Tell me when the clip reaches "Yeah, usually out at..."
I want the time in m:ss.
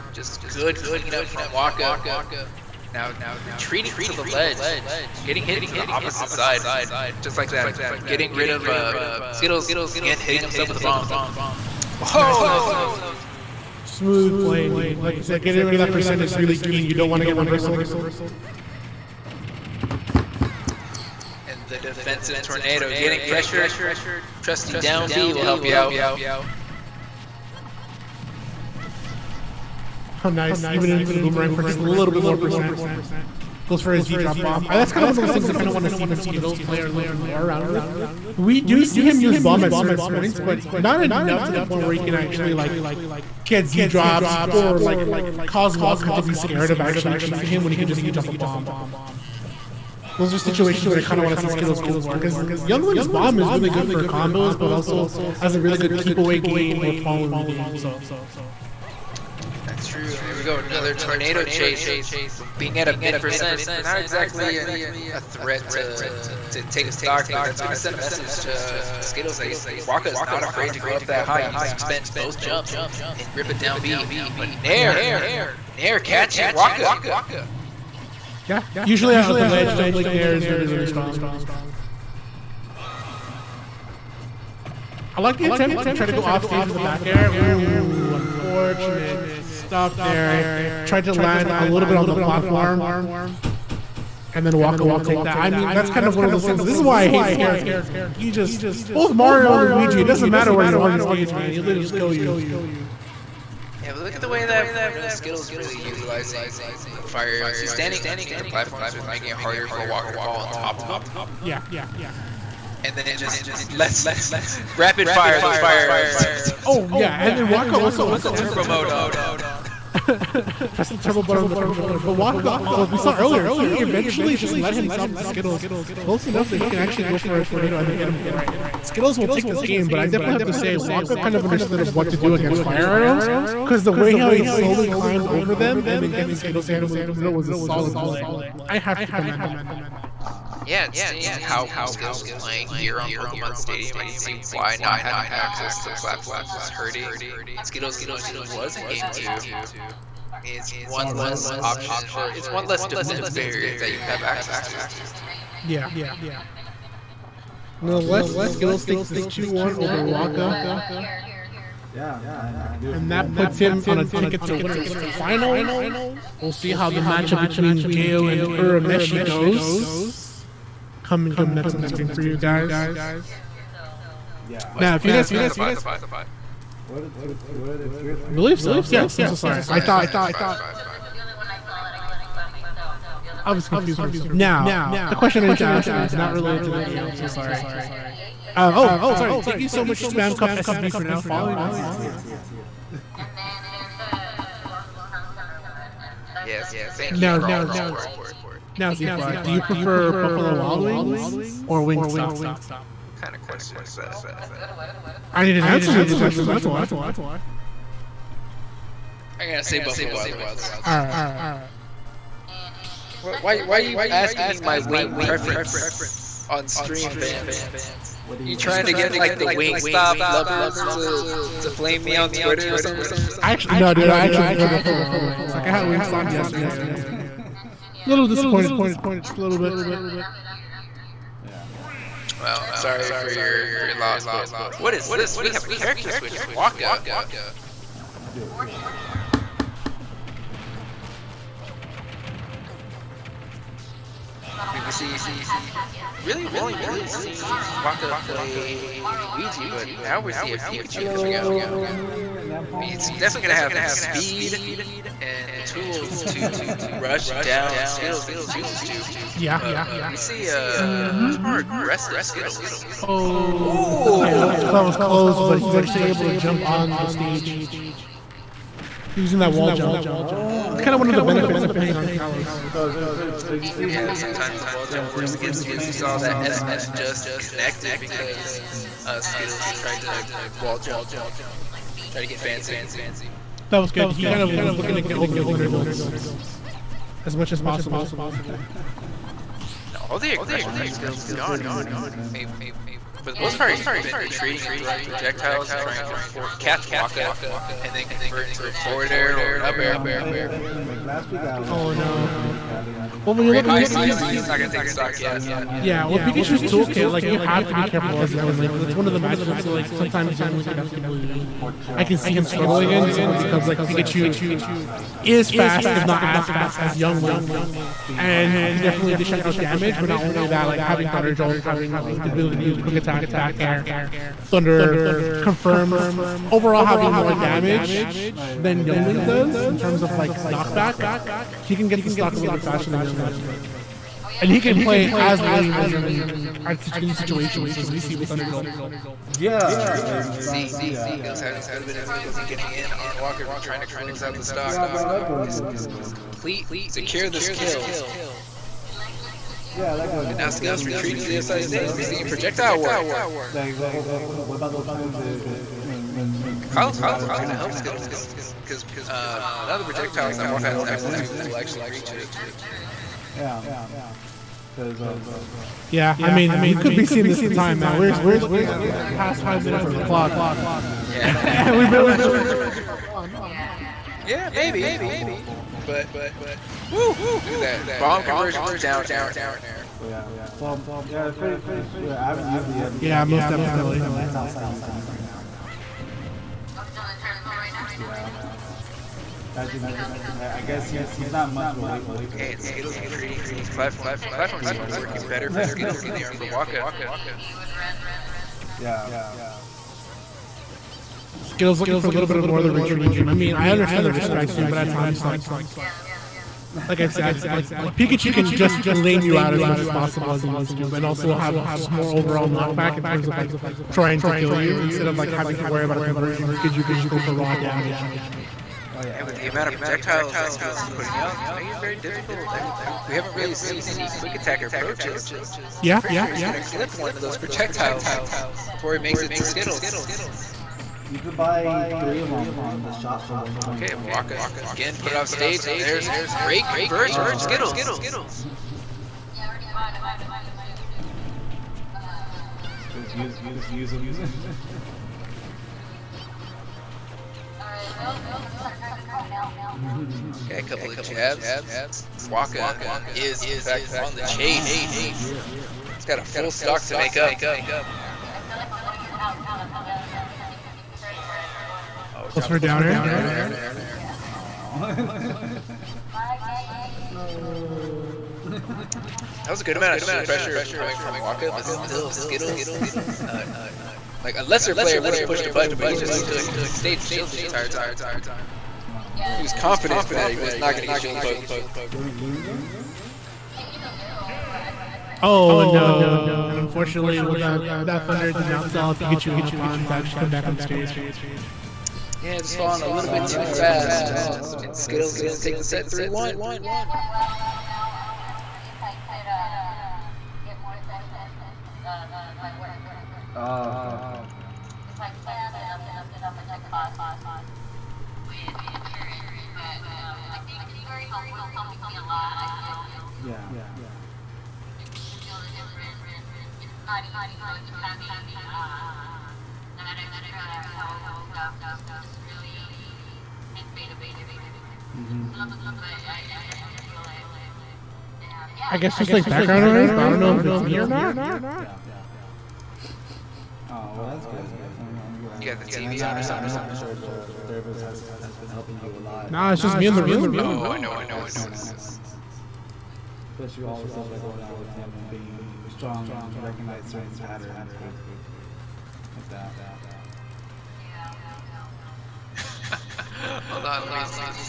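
1:18.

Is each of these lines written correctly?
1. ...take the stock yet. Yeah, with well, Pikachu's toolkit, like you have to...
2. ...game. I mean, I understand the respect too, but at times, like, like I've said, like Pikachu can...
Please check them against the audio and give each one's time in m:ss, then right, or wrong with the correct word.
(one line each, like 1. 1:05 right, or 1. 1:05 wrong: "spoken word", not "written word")
1. 5:04 right
2. 6:43 right.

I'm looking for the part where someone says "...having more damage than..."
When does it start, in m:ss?
5:26.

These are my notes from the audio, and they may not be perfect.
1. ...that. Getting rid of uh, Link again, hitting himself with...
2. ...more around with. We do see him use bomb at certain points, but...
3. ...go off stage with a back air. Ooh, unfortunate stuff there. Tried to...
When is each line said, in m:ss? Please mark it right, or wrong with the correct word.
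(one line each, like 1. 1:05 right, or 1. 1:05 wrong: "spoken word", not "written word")
1. 0:07 wrong: "Skittles", not "Link"
2. 0:37 right
3. 1:26 right.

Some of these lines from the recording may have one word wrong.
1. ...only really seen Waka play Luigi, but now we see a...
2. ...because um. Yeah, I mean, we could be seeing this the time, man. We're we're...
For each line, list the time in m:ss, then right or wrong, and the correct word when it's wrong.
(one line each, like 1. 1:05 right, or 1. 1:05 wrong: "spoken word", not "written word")
1. 4:06 right
2. 6:04 right.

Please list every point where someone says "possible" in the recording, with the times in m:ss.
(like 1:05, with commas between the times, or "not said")
4:47, 6:49.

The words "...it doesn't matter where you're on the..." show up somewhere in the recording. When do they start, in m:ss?
1:40.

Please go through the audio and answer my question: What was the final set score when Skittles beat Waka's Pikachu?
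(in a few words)
3-1.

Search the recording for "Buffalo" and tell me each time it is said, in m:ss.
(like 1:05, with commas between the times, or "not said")
3:20, 3:29, 3:44.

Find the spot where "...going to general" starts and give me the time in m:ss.
5:45.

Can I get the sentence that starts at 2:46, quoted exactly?
We'll see how the matchup between Gao and Urameshi goes.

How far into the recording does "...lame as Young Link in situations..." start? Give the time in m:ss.
5:35.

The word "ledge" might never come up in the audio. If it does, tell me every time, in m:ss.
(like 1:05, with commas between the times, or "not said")
0:04, 1:19.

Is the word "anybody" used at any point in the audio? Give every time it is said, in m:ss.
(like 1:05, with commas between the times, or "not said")
not said.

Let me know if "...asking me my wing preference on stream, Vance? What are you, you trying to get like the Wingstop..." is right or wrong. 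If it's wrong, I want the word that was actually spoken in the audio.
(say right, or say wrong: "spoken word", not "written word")
right.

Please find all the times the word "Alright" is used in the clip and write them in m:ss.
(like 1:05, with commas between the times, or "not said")
7:27.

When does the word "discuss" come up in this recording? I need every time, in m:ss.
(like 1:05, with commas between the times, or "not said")
not said.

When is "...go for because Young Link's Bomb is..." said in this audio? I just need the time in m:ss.
0:51.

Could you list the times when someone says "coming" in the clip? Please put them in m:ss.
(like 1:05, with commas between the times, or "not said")
2:51, 4:11, 7:50.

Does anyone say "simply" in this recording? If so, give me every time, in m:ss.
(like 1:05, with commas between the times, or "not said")
5:13.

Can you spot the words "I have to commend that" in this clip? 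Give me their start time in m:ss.
2:18.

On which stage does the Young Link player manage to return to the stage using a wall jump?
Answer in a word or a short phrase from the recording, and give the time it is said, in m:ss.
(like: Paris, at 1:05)
Kalos, at 4:32.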